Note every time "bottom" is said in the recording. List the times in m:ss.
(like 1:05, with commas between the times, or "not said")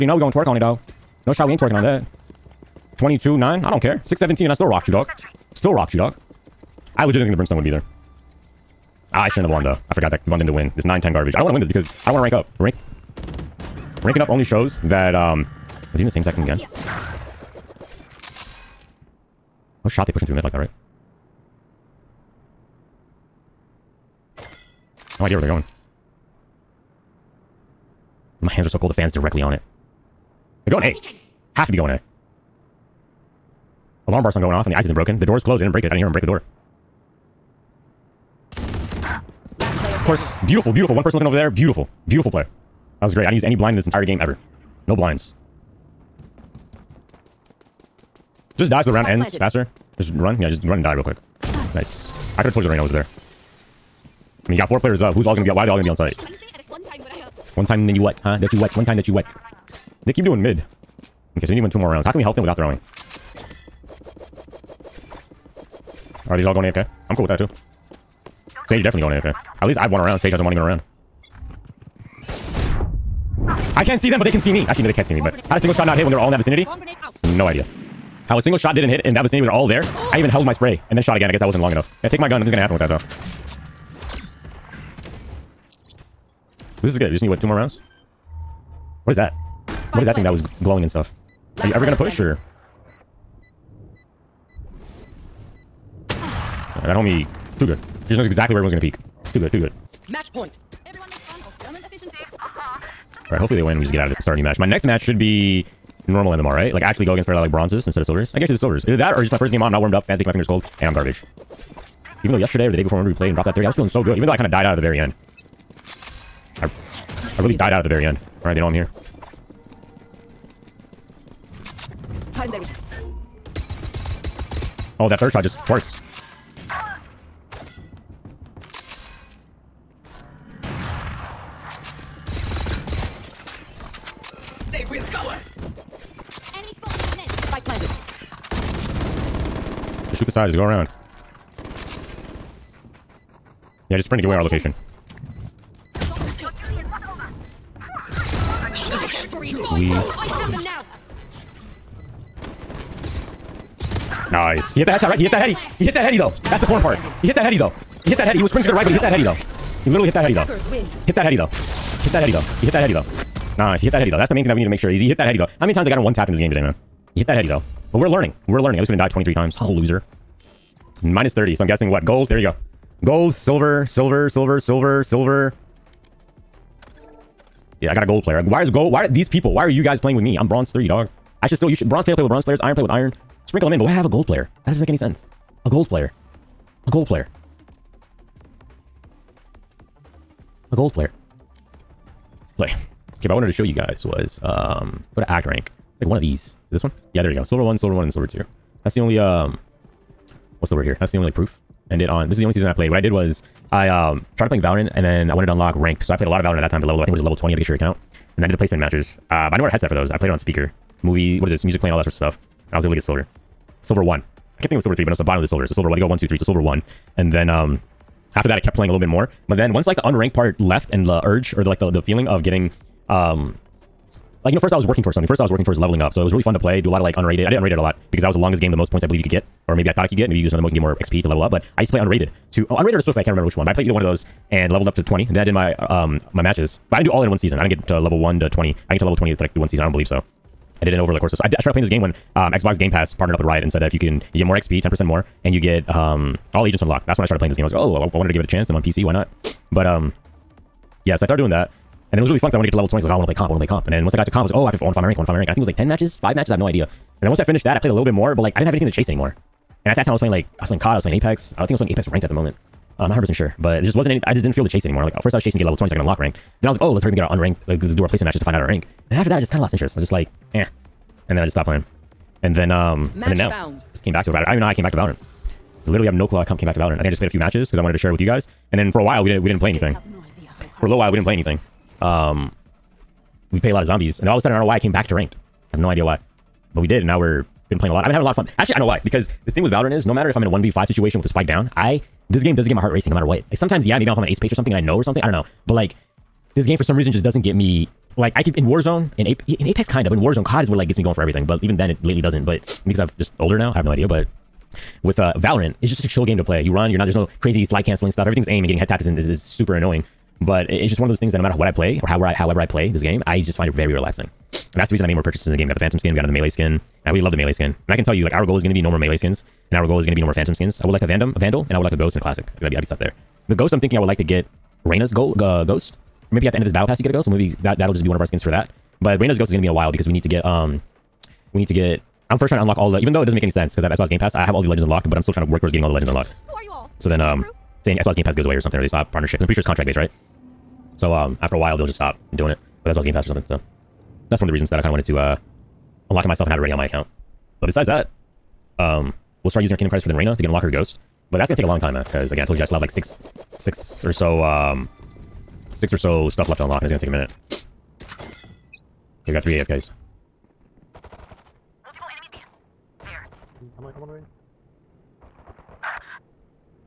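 3:35.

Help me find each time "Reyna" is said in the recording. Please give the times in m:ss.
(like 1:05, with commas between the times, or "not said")
5:24, 5:29, 5:50.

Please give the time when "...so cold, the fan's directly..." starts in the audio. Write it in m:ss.
0:28.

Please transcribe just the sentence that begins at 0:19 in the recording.
What shot they pushing through mid like that, right?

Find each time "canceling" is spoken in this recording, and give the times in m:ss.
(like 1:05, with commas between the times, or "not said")
5:07.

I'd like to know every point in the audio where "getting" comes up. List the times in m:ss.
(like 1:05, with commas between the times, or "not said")
3:42, 5:08, 5:35.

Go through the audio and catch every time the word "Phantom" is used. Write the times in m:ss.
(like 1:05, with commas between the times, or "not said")
5:15, 5:20.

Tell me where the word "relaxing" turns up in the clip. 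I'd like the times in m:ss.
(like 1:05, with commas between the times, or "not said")
5:13.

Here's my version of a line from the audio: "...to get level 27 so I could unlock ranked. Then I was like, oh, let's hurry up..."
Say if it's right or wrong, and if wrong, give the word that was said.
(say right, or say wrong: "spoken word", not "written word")
wrong: "20", not "27".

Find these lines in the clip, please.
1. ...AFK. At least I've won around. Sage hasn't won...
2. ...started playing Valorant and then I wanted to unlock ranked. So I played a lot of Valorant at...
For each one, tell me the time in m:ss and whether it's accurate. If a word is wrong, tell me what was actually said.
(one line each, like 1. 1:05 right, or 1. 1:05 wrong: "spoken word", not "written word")
1. 1:09 right
2. 3:24 right.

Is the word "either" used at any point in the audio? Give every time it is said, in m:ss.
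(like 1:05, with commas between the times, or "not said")
1:48, 3:53.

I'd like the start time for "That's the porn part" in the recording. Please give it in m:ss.
2:36.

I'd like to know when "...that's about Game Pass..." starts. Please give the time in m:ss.
5:42.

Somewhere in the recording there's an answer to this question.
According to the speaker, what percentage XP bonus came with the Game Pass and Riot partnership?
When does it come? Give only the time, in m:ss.
4:04.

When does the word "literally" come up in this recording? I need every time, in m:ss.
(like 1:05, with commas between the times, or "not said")
2:39, 4:35.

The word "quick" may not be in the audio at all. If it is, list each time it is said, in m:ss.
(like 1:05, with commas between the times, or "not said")
0:51.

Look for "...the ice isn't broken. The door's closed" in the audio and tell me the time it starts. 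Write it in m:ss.
0:34.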